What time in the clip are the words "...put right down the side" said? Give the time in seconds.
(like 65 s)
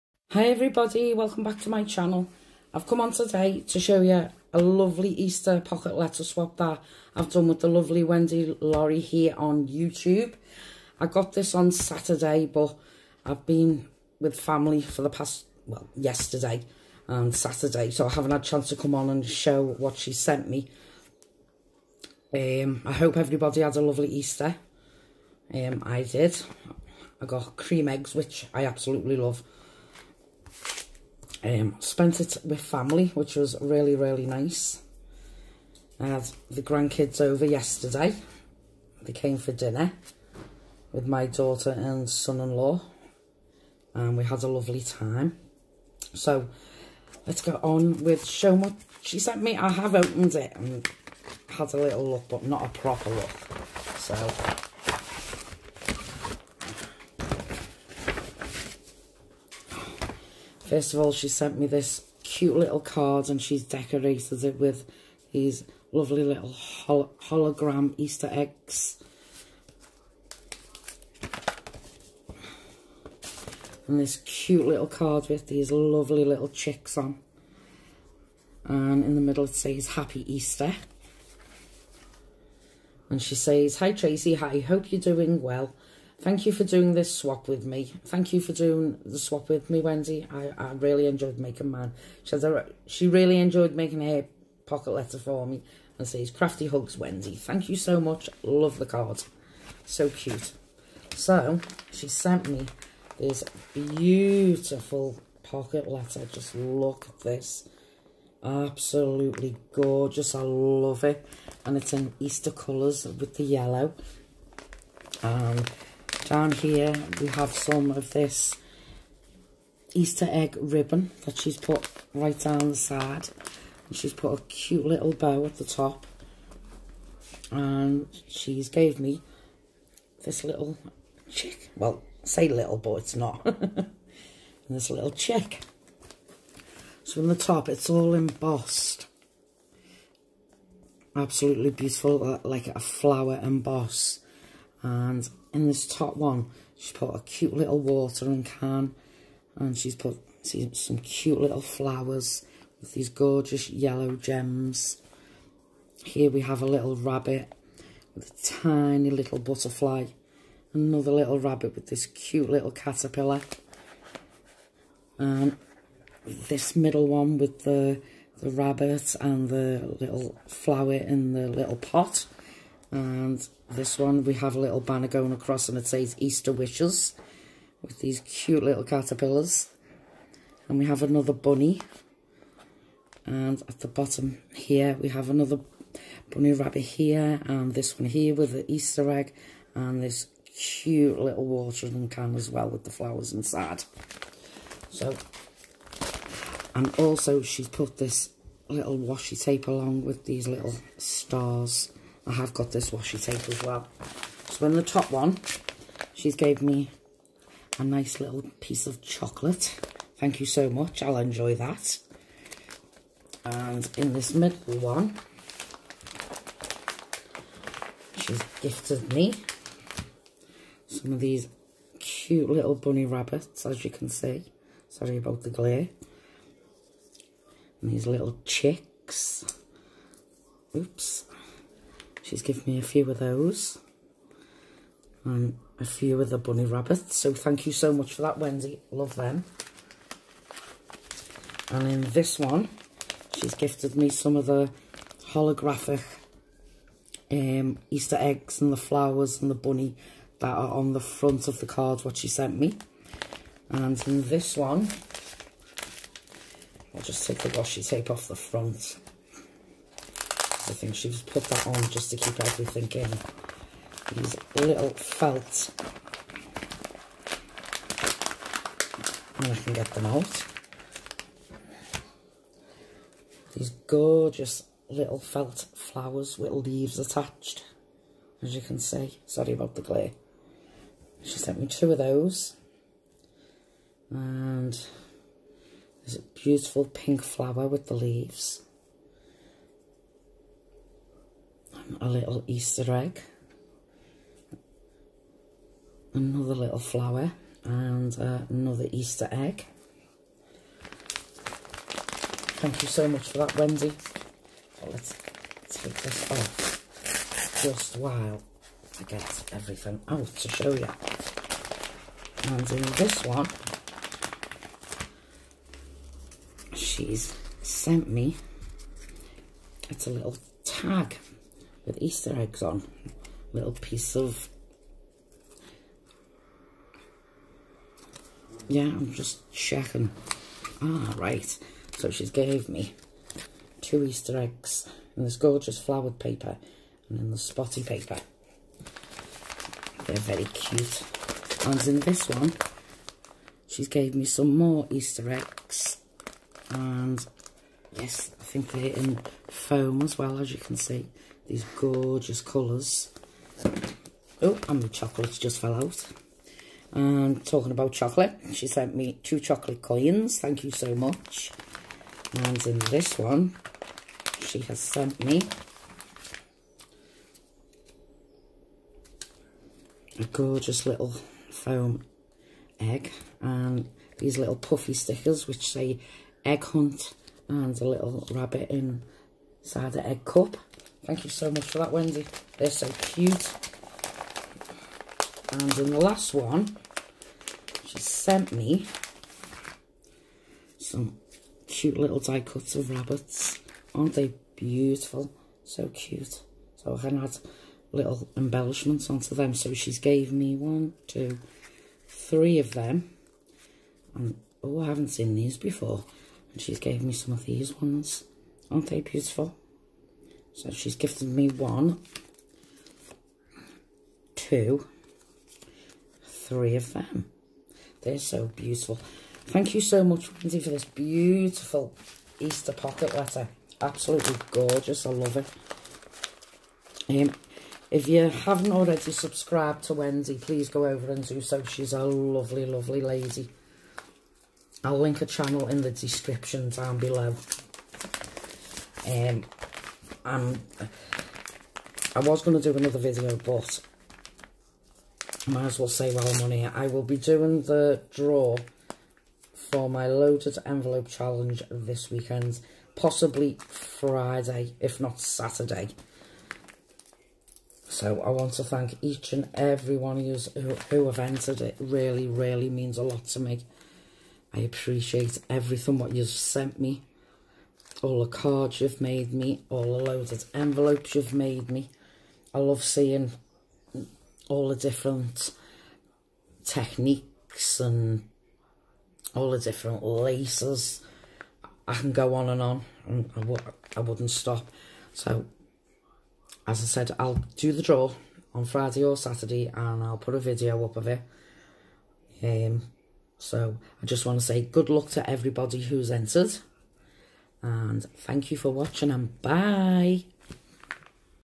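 121 s.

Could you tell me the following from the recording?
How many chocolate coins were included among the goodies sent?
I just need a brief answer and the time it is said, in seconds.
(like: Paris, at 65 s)
2, at 359 s.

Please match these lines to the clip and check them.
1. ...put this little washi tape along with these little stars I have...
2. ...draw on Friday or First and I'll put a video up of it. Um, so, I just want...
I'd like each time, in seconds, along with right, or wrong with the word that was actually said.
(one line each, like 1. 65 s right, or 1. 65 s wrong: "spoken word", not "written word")
1. 197 s right
2. 487 s wrong: "Saturday", not "First".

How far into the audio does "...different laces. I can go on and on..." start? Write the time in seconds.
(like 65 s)
479 s.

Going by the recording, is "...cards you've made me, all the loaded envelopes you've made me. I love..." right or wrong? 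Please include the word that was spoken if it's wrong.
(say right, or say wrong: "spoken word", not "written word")
right.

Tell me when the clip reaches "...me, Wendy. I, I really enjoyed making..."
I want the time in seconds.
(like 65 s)
89 s.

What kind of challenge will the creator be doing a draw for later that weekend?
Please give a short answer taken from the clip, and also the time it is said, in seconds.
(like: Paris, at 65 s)
loaded envelope challenge, at 450 s.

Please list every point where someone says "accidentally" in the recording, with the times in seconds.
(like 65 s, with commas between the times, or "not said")
not said.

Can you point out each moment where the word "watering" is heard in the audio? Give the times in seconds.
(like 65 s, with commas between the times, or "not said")
147 s, 191 s.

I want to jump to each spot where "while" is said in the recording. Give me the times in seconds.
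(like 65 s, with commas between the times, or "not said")
307 s, 446 s.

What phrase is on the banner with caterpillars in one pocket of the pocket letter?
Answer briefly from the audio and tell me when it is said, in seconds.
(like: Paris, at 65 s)
Easter Wishes, at 176 s.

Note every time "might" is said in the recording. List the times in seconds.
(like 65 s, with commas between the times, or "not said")
445 s.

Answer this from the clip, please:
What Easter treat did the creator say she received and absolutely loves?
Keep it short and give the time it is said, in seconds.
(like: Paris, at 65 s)
cream eggs, at 27 s.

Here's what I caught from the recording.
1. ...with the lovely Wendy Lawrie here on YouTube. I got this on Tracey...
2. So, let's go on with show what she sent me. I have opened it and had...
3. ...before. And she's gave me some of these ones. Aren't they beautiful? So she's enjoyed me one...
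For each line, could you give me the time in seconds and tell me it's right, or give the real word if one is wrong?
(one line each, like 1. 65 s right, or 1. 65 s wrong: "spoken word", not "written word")
1. 7 s wrong: "Saturday", not "Tracey"
2. 46 s right
3. 405 s wrong: "gifted", not "enjoyed".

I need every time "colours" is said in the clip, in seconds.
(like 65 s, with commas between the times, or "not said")
112 s, 352 s.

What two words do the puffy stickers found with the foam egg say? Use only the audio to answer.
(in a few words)
egg hunt.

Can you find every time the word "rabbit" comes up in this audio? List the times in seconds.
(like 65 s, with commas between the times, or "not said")
156 s, 161 s, 168 s, 186 s, 223 s, 236 s, 378 s, 392 s.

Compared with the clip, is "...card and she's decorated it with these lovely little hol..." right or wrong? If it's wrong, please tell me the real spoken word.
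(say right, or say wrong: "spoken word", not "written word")
right.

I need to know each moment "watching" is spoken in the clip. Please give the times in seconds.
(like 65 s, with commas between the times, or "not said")
498 s.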